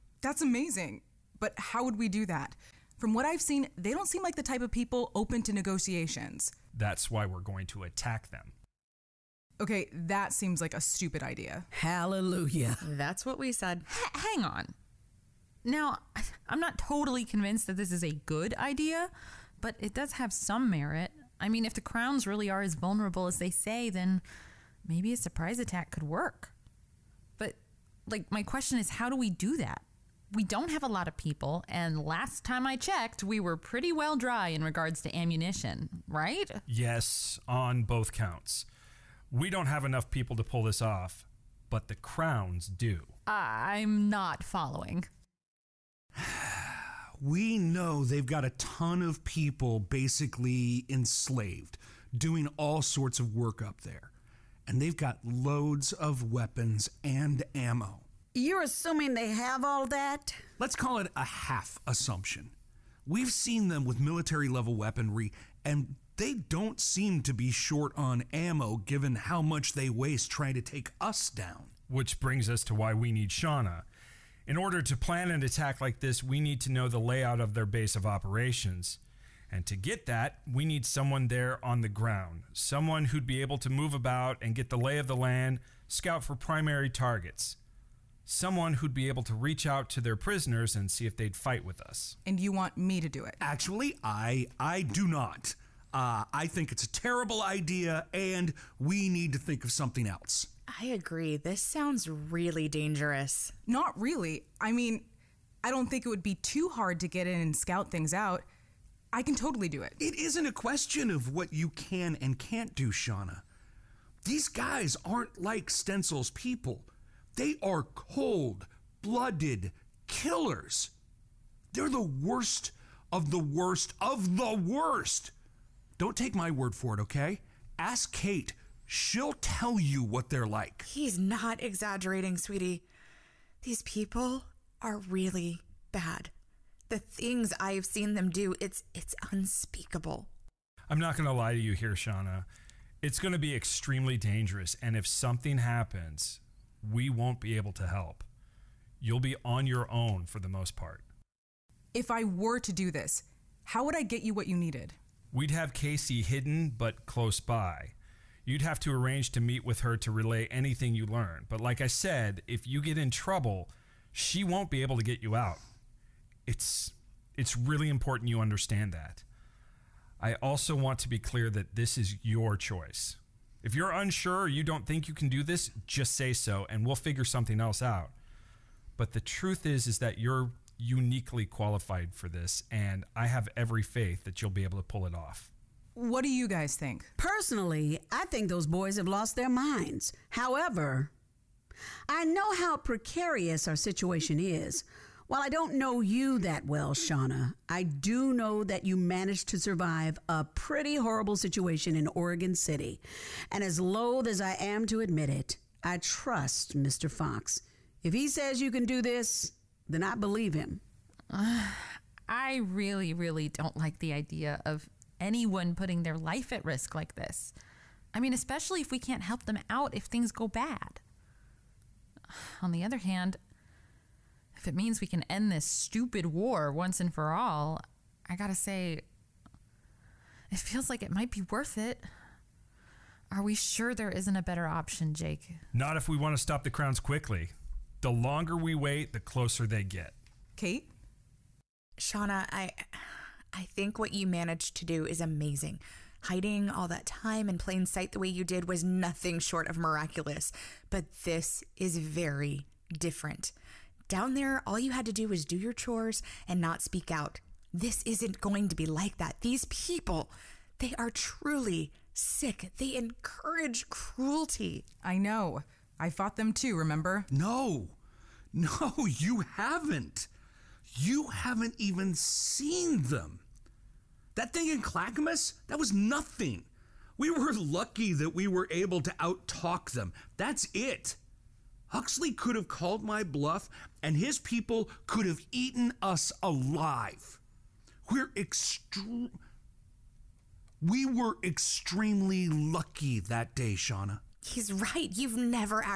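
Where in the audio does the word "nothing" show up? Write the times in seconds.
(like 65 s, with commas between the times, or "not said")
248 s, 275 s.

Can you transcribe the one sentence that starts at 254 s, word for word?
Down there, all you had to do was do your chores and not speak out.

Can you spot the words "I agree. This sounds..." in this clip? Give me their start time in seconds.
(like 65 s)
100 s.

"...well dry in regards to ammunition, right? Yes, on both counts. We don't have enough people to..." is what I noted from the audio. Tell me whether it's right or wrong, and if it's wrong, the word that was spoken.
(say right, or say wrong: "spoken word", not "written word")
right.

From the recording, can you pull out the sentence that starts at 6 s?
That's why we're going to attack them.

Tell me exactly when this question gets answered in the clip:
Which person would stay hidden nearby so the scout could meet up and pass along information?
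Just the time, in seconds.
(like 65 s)
155 s.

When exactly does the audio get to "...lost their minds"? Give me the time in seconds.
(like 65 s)
189 s.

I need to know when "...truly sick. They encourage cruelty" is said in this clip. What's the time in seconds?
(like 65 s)
261 s.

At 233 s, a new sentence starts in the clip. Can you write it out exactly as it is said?
Are we sure there isn't a better option, Jake?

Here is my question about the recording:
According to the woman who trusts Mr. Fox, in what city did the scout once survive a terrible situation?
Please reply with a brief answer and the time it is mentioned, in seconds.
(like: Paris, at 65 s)
Oregon City, at 202 s.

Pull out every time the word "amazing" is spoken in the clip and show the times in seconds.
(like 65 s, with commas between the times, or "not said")
0 s, 245 s.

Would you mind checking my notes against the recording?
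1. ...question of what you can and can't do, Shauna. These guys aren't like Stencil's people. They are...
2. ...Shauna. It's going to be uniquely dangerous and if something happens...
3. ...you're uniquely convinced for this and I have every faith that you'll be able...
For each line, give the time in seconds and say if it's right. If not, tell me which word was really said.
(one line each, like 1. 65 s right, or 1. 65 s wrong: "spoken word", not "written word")
1. 110 s right
2. 141 s wrong: "extremely", not "uniquely"
3. 180 s wrong: "qualified", not "convinced".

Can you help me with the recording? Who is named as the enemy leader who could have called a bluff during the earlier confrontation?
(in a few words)
Huxley.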